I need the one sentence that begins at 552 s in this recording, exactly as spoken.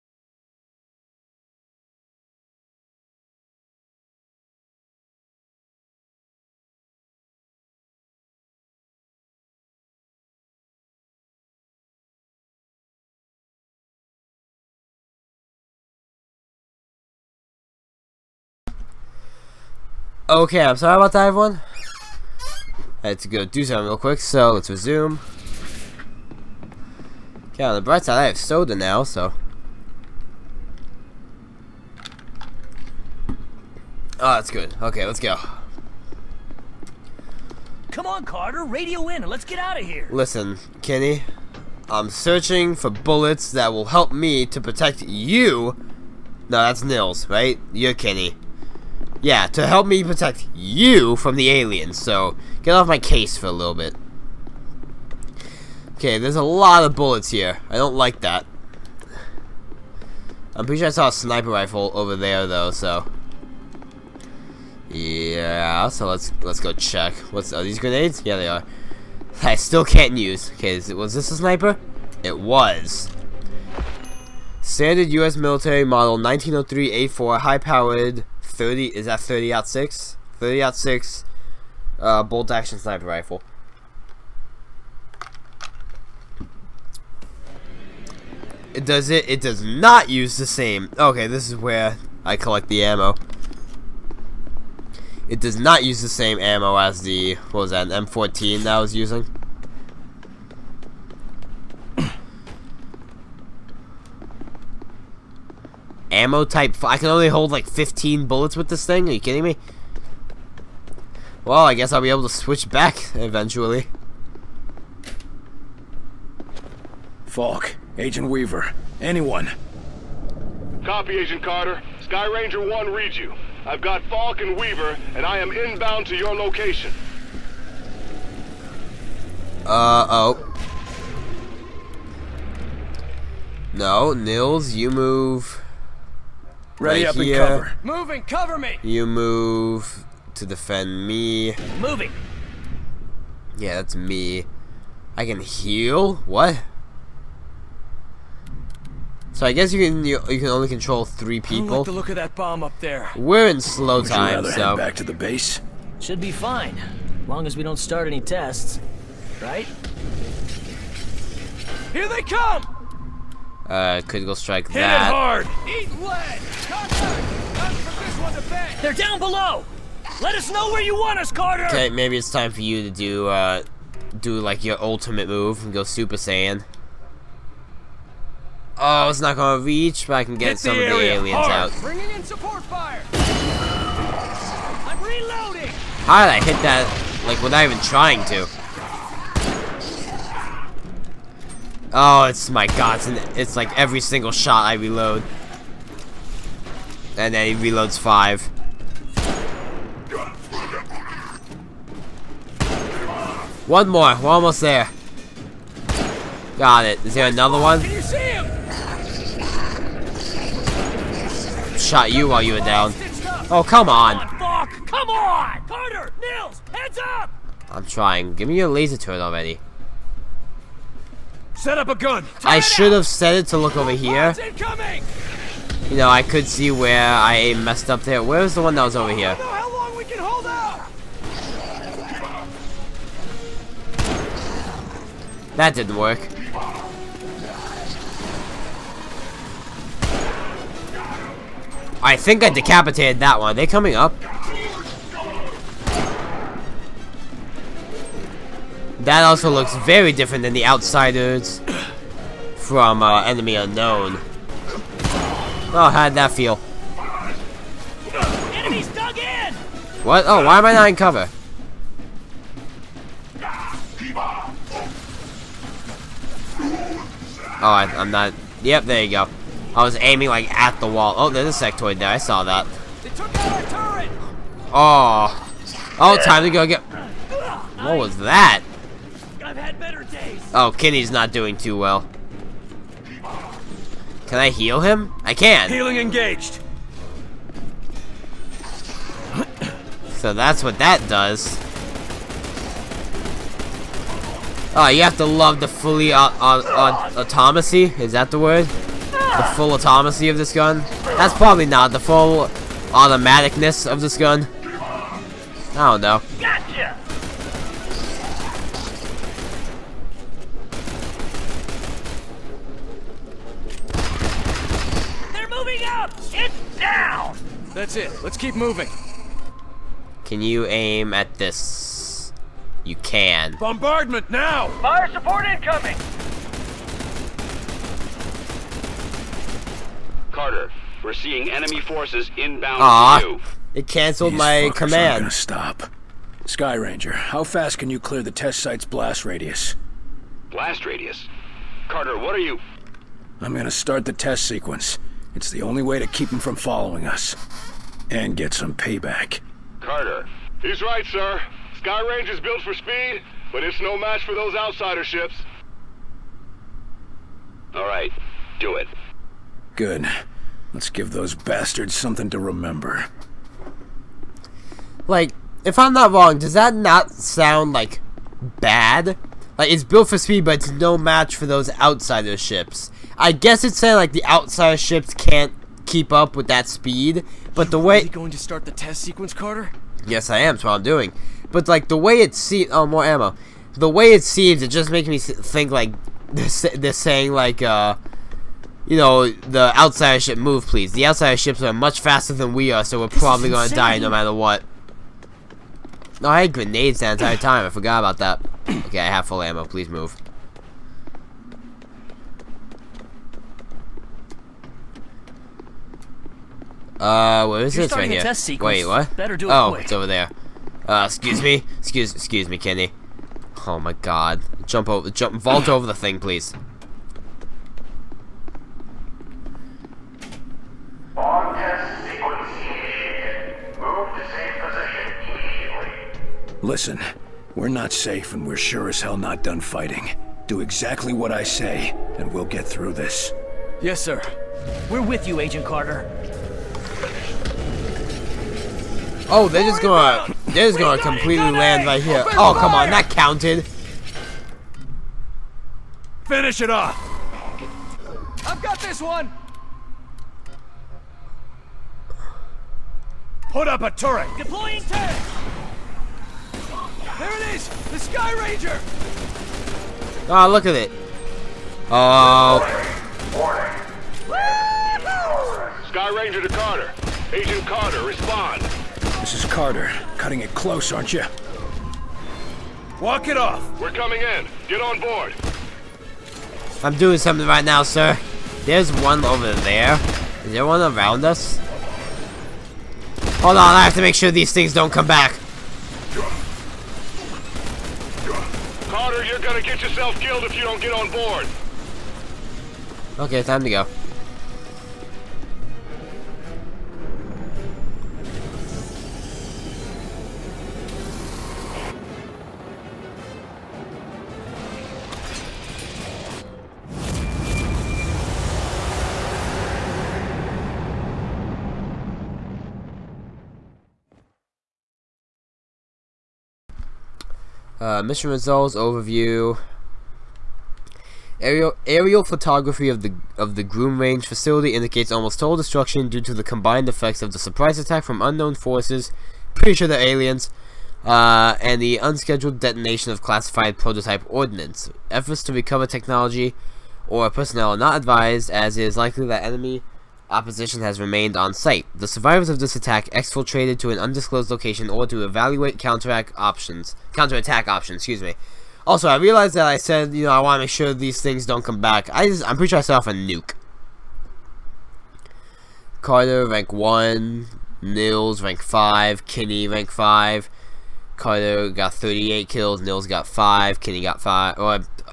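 I just, I'm pretty sure I set off a nuke.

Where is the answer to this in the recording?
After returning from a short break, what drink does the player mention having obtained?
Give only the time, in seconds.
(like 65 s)
28 s.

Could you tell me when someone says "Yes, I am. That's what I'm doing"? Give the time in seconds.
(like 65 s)
380 s.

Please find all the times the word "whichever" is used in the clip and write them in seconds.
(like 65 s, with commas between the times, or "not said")
not said.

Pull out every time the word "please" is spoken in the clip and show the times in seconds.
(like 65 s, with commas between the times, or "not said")
390 s, 399 s, 416 s.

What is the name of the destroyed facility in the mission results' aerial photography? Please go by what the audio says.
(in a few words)
Groom Range.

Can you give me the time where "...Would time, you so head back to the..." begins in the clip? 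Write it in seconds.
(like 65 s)
154 s.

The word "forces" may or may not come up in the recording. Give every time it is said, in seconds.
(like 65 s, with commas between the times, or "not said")
331 s, 528 s.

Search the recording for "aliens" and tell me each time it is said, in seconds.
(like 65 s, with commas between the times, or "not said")
51 s, 181 s, 529 s.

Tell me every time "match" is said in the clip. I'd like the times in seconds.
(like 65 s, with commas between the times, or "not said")
353 s, 370 s.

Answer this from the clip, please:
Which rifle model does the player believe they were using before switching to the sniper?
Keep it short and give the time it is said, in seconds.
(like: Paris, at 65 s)
M14, at 98 s.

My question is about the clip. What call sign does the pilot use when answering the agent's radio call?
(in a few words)
Sky Ranger 1.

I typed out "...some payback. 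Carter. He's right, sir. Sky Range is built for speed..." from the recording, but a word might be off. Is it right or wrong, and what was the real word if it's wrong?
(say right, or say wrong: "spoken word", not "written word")
right.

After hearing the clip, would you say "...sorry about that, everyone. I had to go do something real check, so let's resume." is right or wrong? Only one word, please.
wrong.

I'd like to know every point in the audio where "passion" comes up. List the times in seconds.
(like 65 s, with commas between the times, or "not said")
not said.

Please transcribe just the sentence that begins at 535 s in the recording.
Efforts to recover technology or personnel are not advised, as it is likely that enemy opposition has remained on site.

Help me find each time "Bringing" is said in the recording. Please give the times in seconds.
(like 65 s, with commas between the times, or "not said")
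181 s.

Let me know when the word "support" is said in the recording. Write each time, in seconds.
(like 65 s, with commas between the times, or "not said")
182 s, 325 s.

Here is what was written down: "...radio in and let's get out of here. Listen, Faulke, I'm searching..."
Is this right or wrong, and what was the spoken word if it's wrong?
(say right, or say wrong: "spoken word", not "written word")
wrong: "Kinney", not "Faulke".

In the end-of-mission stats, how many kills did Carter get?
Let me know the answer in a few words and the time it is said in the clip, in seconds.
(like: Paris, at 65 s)
38, at 561 s.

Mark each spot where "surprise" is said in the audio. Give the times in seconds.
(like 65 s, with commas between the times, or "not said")
527 s.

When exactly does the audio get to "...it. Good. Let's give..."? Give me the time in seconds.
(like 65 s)
358 s.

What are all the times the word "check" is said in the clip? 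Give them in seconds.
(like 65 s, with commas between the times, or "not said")
66 s.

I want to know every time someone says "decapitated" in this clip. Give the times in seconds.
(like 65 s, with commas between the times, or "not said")
242 s.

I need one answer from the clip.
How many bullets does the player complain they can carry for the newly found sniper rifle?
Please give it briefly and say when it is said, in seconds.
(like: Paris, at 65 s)
15, at 107 s.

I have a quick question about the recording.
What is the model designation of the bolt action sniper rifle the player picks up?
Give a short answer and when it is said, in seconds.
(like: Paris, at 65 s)
1903 A4, at 76 s.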